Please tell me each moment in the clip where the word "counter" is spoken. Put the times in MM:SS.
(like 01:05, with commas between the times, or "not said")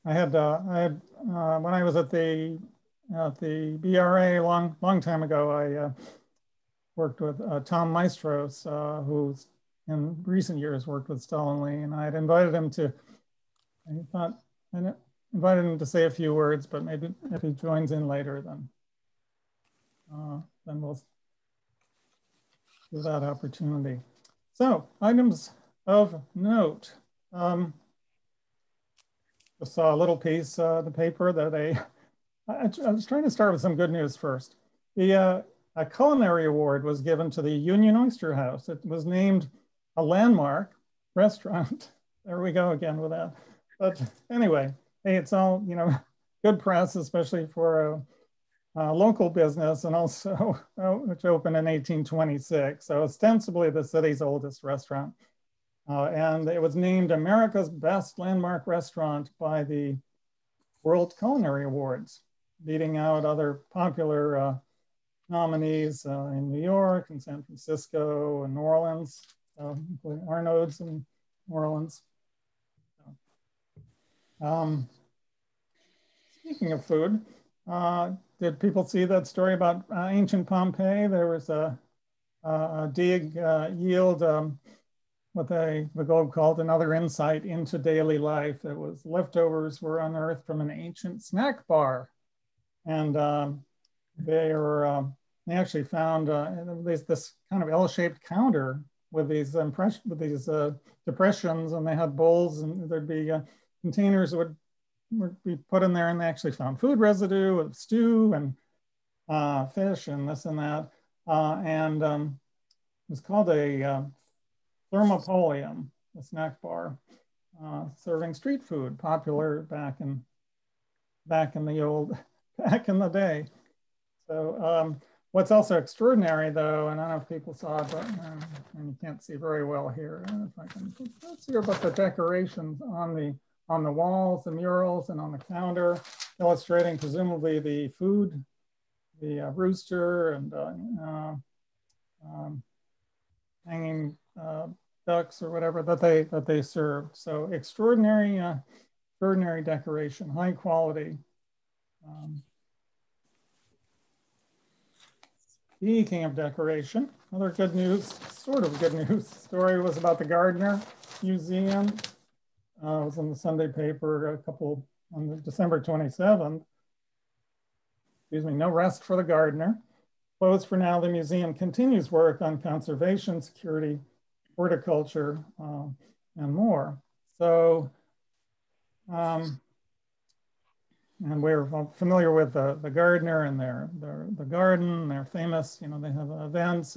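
01:38, 02:15.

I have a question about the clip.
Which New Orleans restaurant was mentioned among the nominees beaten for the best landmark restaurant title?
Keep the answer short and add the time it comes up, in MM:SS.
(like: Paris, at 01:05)
Arnold's, at 01:10.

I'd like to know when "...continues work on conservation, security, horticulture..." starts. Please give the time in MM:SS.
02:51.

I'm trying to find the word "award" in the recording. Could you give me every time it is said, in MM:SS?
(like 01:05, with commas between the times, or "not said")
00:36, 01:01.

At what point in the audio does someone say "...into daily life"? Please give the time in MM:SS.
01:27.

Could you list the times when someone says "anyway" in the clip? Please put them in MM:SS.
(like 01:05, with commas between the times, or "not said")
00:44.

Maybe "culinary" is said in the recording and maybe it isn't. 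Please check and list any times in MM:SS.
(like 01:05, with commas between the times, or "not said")
00:35, 01:01.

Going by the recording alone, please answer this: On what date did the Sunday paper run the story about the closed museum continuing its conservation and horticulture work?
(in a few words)
December 27th.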